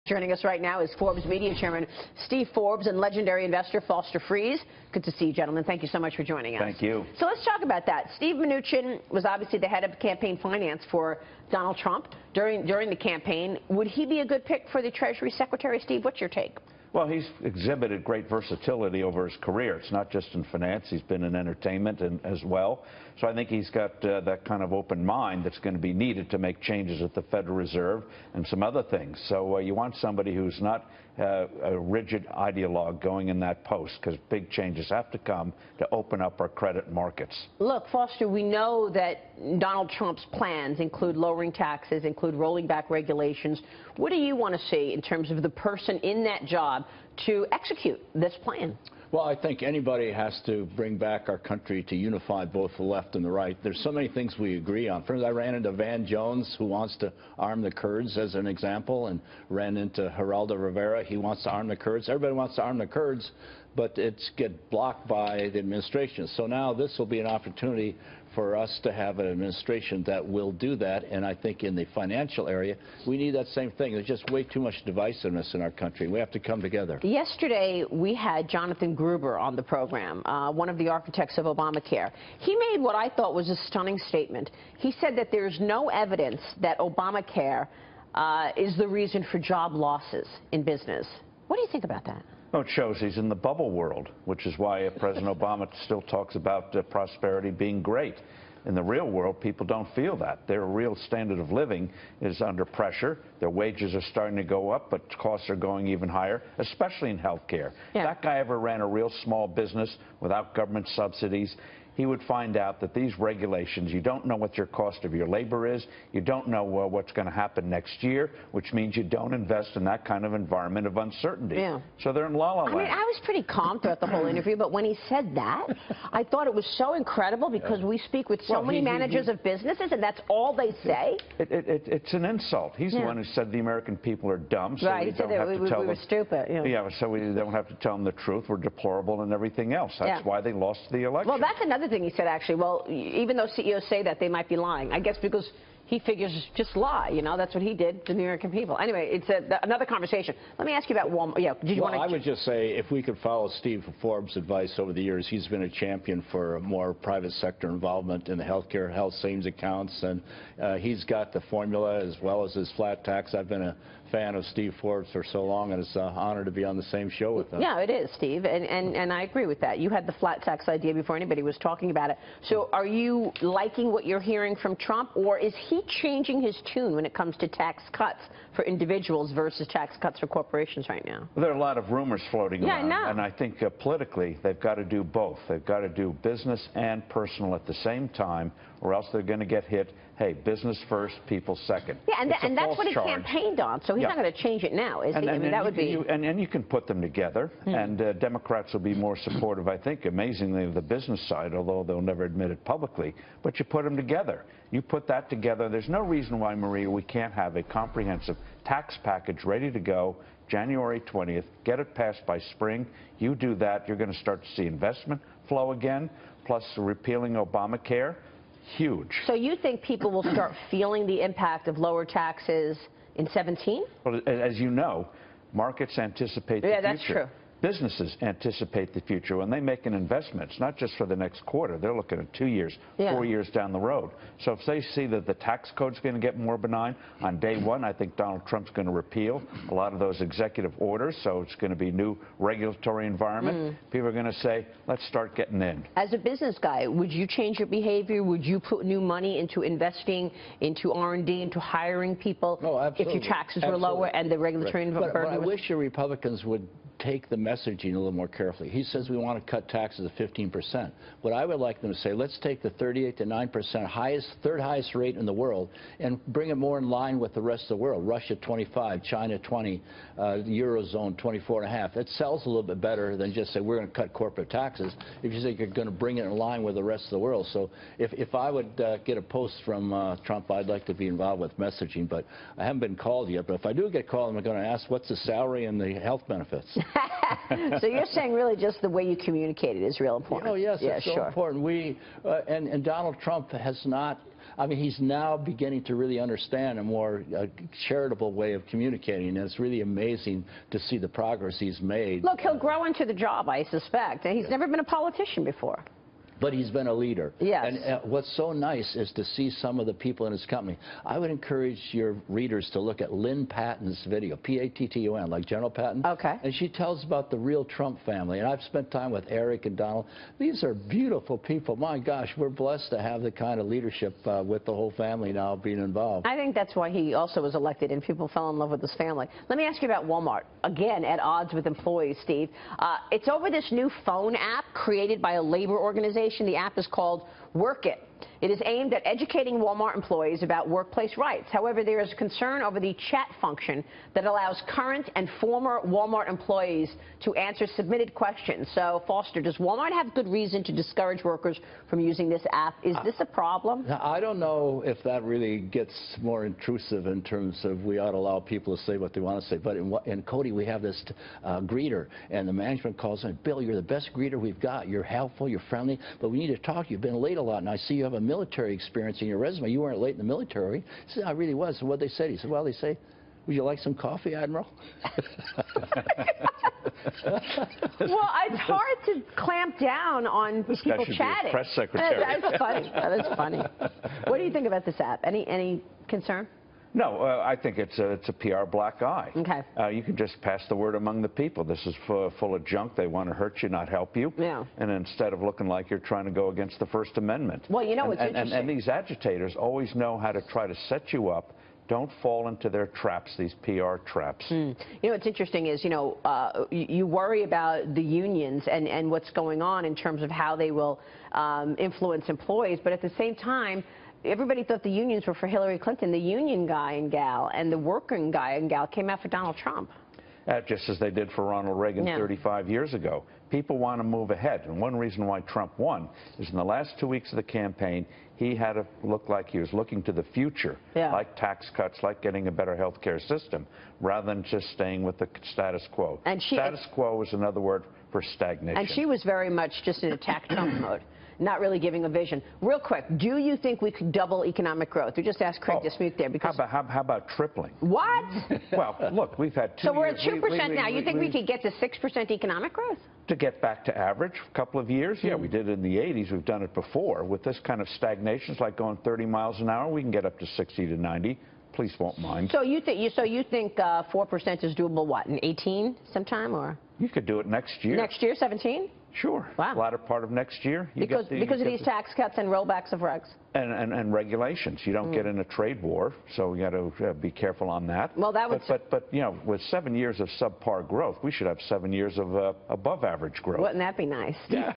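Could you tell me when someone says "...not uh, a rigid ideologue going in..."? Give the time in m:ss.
0:30.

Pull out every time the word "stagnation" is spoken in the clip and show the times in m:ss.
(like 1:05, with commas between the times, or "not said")
7:18, 7:37.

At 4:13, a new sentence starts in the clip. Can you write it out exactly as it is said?
were lower and the regulatory right.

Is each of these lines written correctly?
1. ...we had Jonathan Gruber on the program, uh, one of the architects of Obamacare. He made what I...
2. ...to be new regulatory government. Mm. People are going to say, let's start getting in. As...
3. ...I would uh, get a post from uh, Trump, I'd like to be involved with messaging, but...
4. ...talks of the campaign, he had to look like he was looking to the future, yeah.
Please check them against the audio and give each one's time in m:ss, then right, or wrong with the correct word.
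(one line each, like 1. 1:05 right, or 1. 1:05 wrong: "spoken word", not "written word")
1. 1:17 right
2. 4:01 wrong: "environment", not "government"
3. 4:38 right
4. 7:07 wrong: "weeks", not "talks".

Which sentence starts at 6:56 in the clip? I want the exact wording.
The union guy and gal and the working guy and gal came out for Donald Trump.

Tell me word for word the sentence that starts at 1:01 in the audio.
He wants to arm the Kurds.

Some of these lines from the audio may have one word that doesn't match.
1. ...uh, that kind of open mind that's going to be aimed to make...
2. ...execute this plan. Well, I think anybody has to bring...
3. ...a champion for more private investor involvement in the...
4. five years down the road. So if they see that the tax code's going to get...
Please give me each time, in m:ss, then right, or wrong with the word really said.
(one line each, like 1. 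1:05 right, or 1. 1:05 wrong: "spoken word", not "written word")
1. 0:24 wrong: "needed", not "aimed"
2. 0:47 right
3. 2:35 wrong: "sector", not "investor"
4. 3:53 wrong: "four", not "five".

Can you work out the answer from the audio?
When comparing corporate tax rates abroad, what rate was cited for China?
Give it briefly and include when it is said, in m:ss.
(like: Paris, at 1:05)
20%, at 4:29.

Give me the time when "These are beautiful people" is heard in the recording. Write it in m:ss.
5:20.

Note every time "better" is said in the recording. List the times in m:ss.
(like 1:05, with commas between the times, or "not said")
4:32, 7:12.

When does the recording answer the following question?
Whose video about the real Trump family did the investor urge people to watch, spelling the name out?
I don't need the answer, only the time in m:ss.
5:13.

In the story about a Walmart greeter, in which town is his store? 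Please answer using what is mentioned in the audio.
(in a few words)
Cody.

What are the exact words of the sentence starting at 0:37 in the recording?
Look, Foster, we know that Donald Trump's plans include lowering taxes, include rolling back regulations.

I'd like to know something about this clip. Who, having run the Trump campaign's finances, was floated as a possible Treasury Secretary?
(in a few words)
Steve Mnuchin.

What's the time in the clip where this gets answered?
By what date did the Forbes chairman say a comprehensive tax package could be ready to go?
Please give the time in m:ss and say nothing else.
3:30.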